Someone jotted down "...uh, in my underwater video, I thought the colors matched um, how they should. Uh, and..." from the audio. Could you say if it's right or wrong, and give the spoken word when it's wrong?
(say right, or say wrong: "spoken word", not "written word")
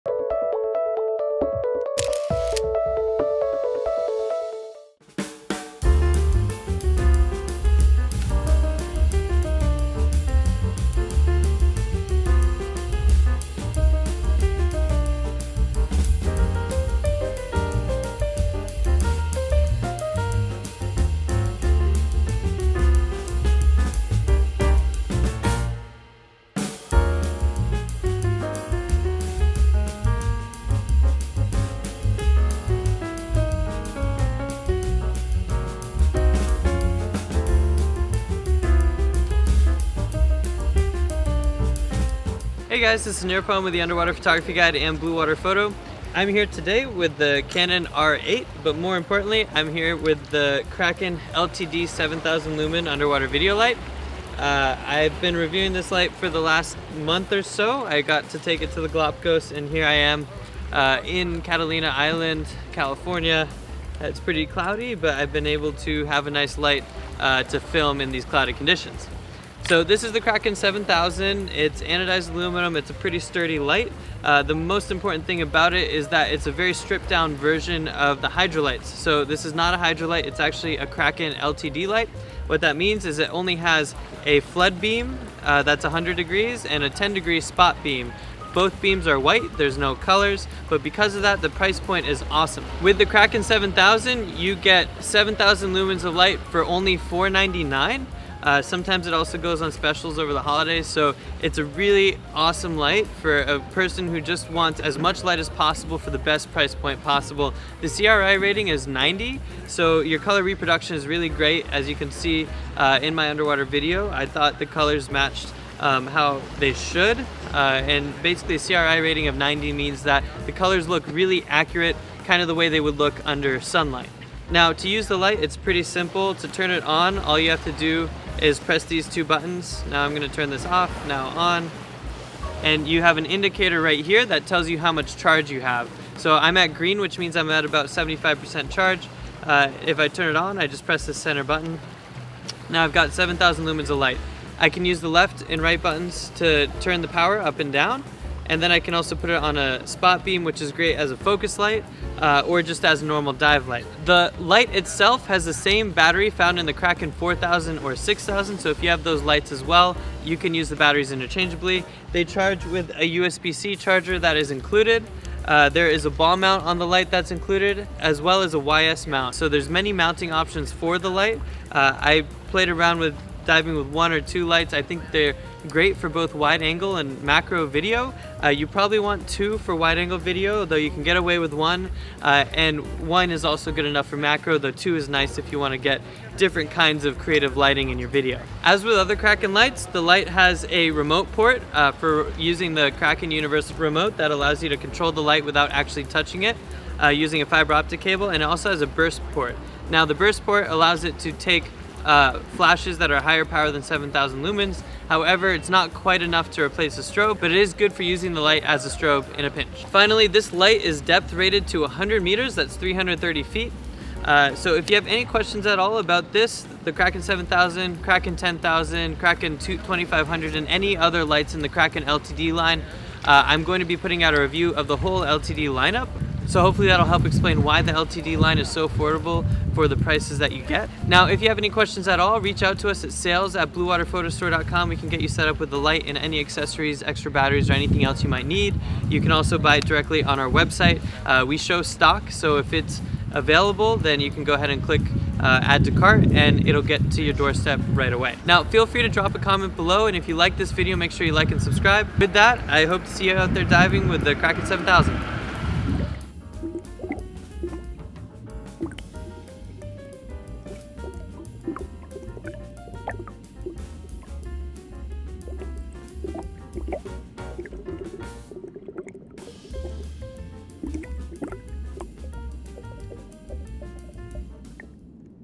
right.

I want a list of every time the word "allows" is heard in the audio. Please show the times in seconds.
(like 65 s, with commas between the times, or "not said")
194 s, 200 s.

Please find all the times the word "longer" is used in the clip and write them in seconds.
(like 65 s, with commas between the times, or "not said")
not said.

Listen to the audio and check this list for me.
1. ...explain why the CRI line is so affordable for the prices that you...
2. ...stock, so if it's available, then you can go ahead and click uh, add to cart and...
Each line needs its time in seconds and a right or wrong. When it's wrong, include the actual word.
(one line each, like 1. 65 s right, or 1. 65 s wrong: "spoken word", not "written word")
1. 227 s wrong: "LTD", not "CRI"
2. 241 s right.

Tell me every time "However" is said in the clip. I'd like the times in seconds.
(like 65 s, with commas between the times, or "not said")
205 s.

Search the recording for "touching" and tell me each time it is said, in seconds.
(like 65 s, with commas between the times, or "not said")
196 s.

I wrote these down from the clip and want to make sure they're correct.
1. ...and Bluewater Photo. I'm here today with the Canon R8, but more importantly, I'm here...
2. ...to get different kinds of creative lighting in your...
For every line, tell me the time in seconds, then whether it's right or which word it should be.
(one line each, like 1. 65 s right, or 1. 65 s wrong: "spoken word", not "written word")
1. 44 s right
2. 185 s right.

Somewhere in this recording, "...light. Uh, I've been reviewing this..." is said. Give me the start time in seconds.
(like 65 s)
53 s.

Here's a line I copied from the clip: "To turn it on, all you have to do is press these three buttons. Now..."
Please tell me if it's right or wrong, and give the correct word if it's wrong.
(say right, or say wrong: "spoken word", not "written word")
wrong: "two", not "three".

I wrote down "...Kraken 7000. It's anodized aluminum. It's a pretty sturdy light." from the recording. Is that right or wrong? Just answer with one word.
right.